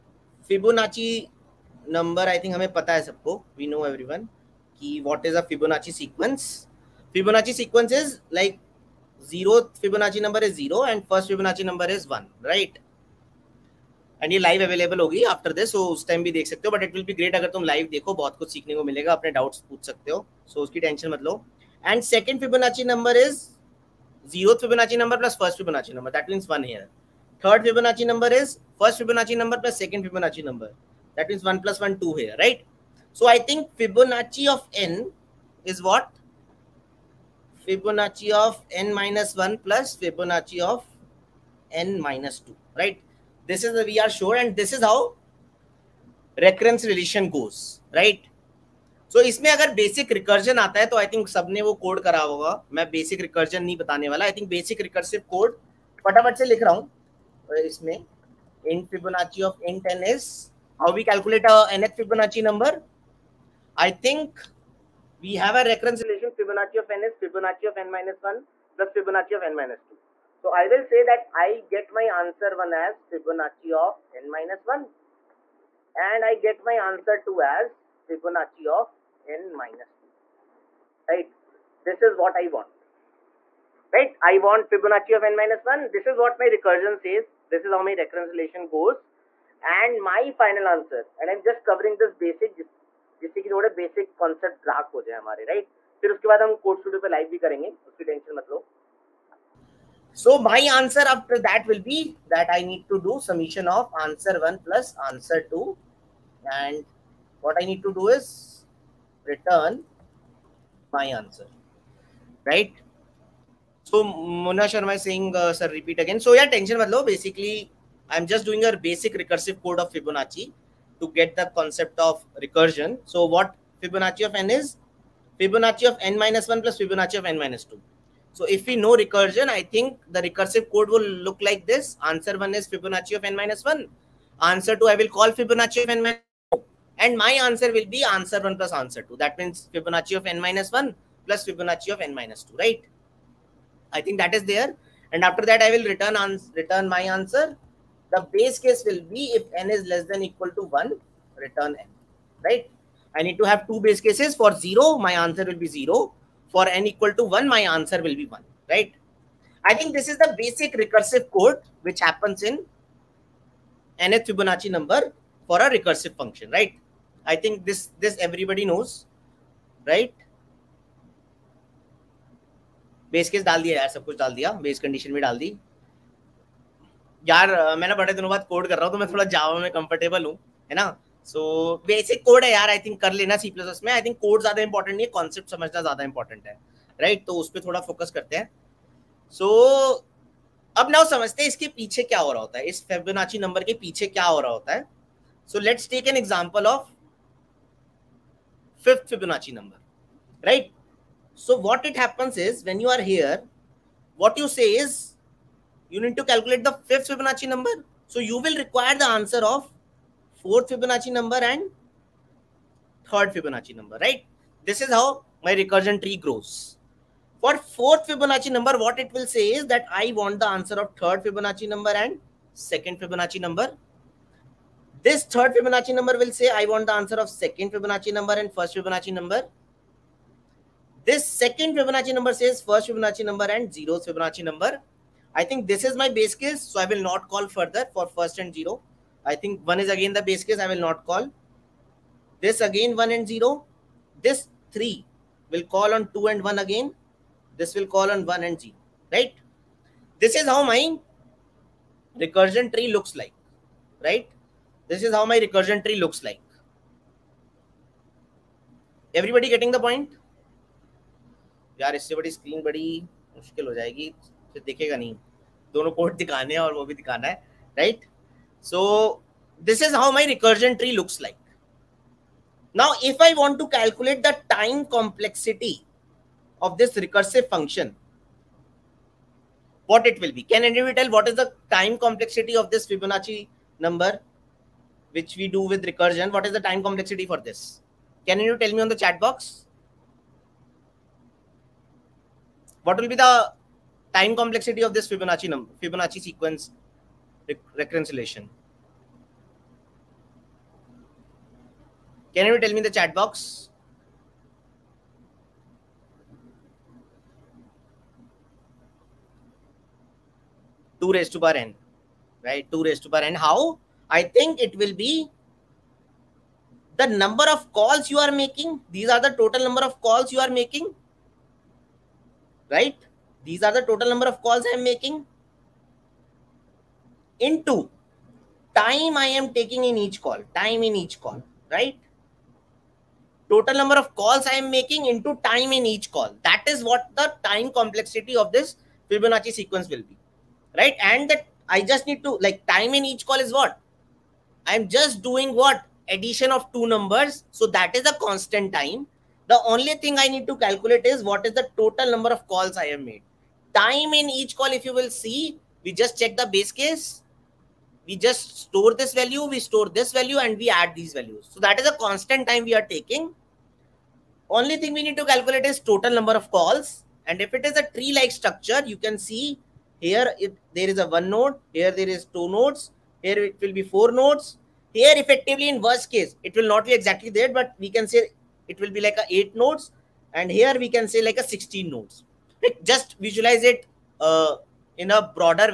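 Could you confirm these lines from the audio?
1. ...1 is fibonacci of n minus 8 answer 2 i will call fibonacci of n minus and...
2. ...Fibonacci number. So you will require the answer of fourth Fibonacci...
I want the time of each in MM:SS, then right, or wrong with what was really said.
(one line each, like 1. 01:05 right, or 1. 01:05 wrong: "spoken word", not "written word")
1. 02:12 wrong: "1", not "8"
2. 03:27 right.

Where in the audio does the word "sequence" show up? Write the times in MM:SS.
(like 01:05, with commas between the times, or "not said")
04:56, 05:39.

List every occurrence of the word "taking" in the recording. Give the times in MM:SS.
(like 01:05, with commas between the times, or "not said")
05:29, 06:02.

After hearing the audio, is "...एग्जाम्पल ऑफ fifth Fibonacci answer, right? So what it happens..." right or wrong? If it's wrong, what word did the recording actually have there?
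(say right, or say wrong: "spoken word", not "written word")
wrong: "number", not "answer".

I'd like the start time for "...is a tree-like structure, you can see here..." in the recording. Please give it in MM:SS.
06:07.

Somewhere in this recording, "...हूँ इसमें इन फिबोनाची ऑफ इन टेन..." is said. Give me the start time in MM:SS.
00:56.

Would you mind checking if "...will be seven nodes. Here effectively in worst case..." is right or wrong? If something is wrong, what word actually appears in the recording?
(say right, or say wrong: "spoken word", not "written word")
wrong: "four", not "seven".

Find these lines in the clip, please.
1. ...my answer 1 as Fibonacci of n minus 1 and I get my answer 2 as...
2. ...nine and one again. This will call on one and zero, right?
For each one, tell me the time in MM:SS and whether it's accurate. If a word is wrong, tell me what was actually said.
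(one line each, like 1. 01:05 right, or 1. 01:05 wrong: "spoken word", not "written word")
1. 01:11 right
2. 04:06 wrong: "two", not "nine".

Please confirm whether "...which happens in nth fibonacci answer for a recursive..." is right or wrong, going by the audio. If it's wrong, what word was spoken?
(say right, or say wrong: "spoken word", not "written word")
wrong: "number", not "answer".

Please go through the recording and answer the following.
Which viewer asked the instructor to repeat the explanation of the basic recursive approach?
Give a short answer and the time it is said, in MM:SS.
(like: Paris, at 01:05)
Mona Sharma, at 01:54.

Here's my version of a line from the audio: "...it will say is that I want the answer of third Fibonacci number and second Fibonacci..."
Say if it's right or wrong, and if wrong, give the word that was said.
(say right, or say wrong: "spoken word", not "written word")
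right.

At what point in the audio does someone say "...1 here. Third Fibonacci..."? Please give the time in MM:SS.
00:26.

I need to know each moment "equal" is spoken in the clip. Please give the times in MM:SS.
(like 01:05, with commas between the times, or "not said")
02:30, 02:36.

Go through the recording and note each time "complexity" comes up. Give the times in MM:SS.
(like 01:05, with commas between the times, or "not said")
04:34, 04:42, 04:46, 04:54, 05:37.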